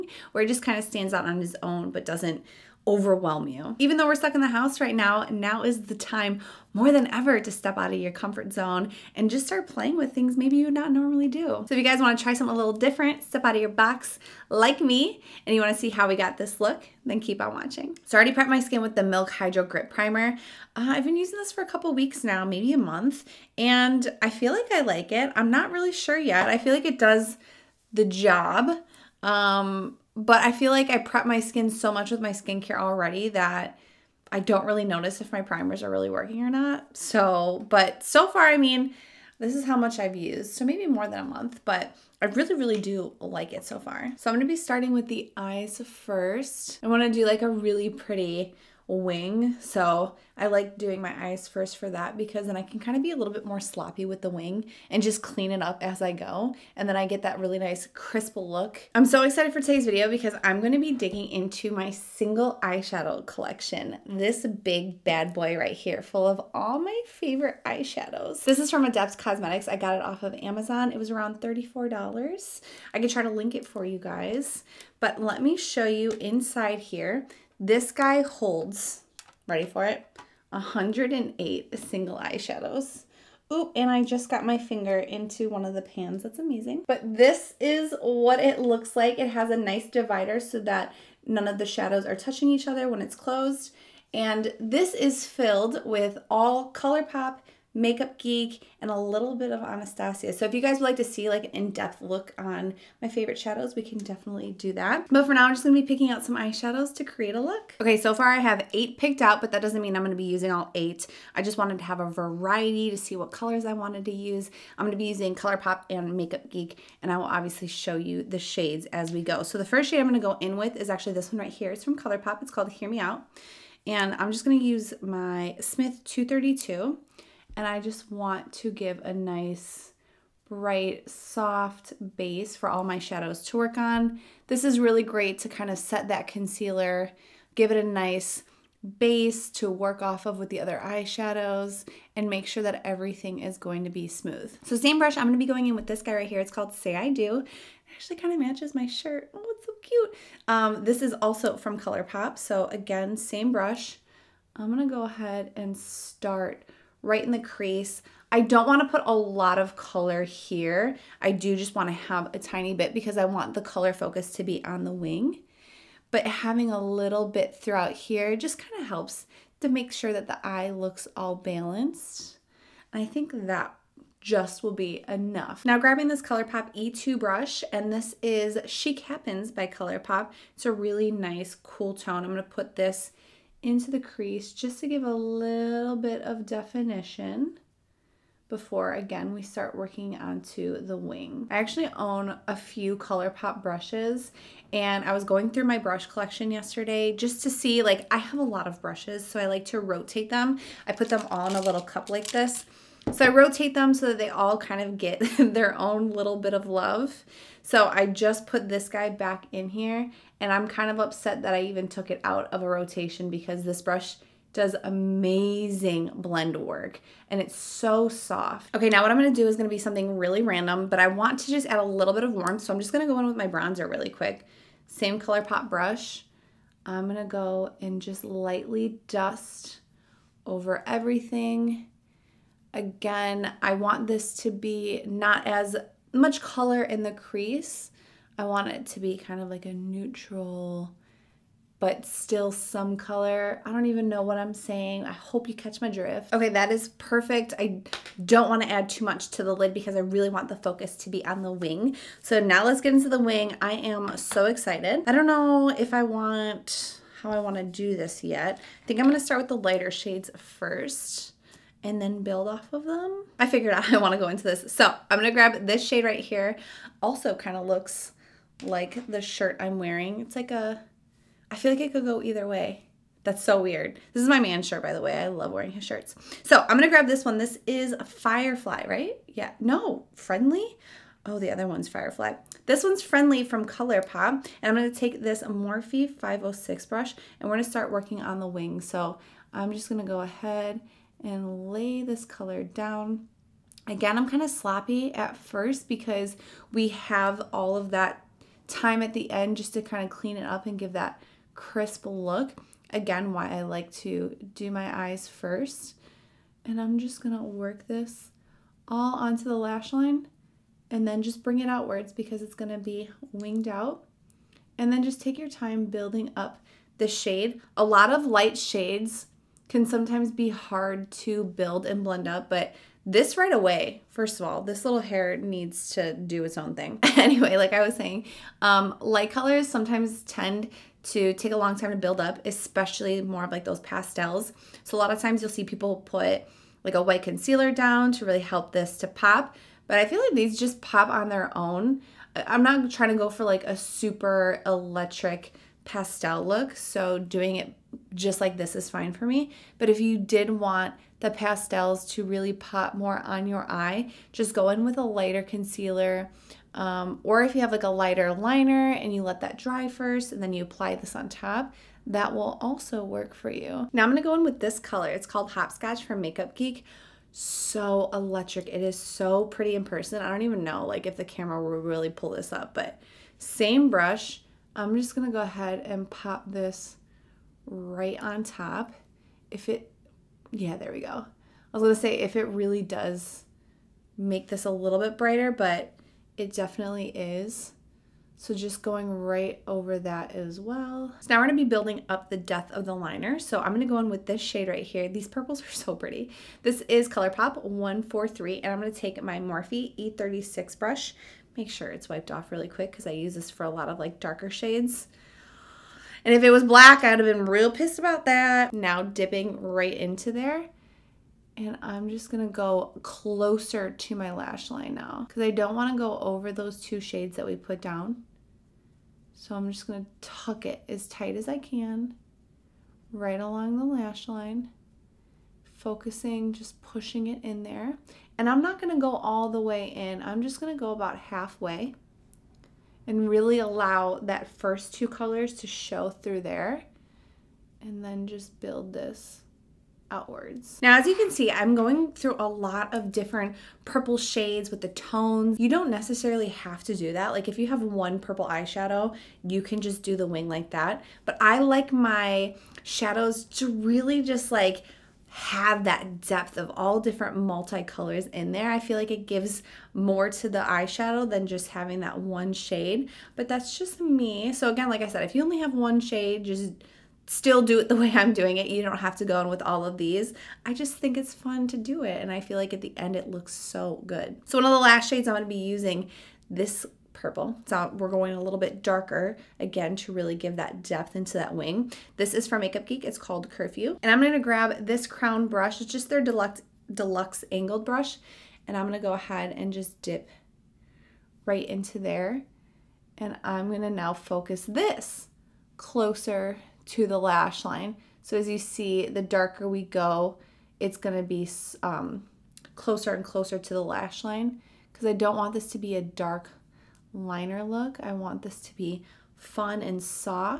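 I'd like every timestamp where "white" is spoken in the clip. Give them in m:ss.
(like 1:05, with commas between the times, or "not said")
5:37.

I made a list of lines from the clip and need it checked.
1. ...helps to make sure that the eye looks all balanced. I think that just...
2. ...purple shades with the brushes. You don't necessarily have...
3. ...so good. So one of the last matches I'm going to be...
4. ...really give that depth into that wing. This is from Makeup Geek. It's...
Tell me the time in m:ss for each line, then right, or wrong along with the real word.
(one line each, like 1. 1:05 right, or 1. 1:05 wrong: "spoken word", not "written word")
1. 2:48 right
2. 7:23 wrong: "tones", not "brushes"
3. 7:53 wrong: "shades", not "matches"
4. 8:00 right.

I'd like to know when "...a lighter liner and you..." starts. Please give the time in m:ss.
5:57.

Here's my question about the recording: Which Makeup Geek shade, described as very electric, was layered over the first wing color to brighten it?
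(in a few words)
Hopscotch.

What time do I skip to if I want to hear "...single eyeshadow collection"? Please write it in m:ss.
1:01.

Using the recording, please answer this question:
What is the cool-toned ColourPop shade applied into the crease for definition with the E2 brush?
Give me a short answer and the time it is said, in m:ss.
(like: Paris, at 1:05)
Chic Happens, at 2:58.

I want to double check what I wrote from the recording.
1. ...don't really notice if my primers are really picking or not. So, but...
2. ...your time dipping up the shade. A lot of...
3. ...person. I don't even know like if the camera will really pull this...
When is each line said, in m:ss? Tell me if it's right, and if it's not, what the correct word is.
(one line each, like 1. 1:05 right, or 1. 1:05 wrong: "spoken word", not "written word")
1. 0:34 wrong: "working", not "picking"
2. 5:15 wrong: "building", not "dipping"
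3. 6:09 right.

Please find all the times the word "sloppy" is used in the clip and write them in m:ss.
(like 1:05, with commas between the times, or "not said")
0:53, 4:54.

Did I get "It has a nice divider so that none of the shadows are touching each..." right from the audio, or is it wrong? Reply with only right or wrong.
right.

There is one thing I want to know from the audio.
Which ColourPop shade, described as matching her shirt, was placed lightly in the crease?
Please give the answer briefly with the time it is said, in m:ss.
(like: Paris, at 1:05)
Say I Do, at 2:26.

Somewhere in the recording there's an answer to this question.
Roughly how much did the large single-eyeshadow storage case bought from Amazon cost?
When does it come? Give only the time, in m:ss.
1:11.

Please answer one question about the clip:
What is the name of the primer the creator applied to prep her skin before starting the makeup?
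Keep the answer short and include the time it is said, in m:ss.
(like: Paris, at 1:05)
Milk Hydro Grip Primer, at 0:19.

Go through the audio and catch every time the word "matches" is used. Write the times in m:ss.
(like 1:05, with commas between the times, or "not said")
2:28.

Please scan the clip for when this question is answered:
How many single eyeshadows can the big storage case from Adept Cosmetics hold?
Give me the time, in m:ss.
1:20.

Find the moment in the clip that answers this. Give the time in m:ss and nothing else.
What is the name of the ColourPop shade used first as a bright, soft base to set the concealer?
2:02.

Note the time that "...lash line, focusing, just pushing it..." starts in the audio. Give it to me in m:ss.
7:03.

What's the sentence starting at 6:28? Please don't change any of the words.
So just going right over that as well.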